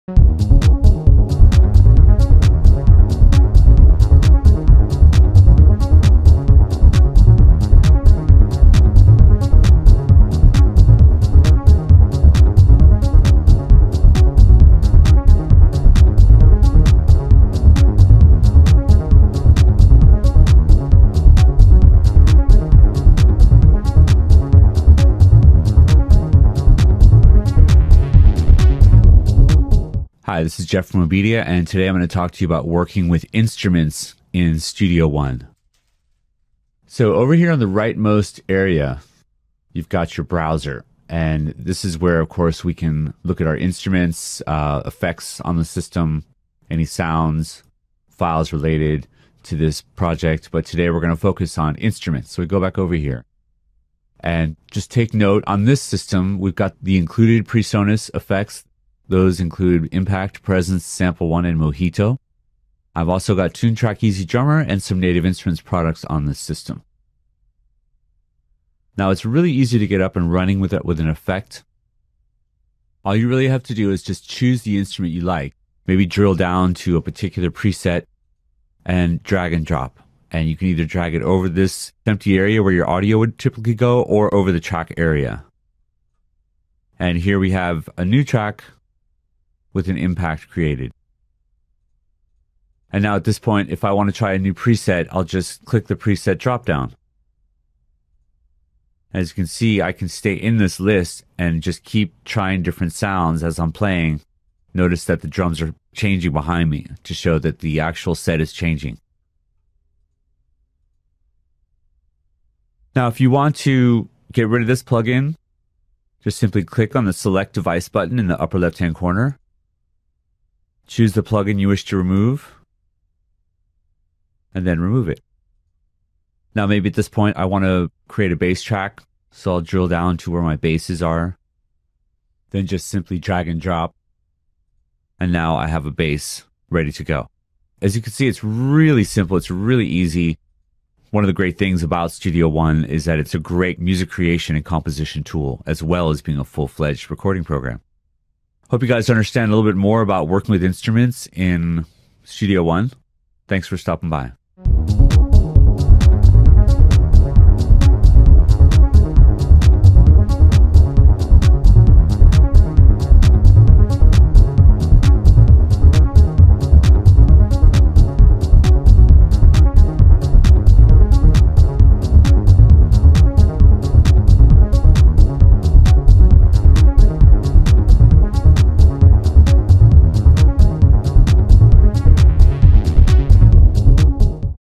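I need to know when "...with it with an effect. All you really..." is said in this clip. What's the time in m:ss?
1:10.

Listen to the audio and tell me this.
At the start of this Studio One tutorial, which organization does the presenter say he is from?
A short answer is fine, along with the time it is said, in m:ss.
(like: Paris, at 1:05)
Obedia, at 0:31.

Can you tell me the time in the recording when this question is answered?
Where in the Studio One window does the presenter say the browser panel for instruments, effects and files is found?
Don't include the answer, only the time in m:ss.
0:37.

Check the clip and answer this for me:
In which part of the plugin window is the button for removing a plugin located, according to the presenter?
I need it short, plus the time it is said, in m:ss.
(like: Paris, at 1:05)
Upper left hand corner, at 1:58.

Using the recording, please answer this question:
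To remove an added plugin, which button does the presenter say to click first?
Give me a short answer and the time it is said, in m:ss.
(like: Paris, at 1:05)
Select device, at 1:57.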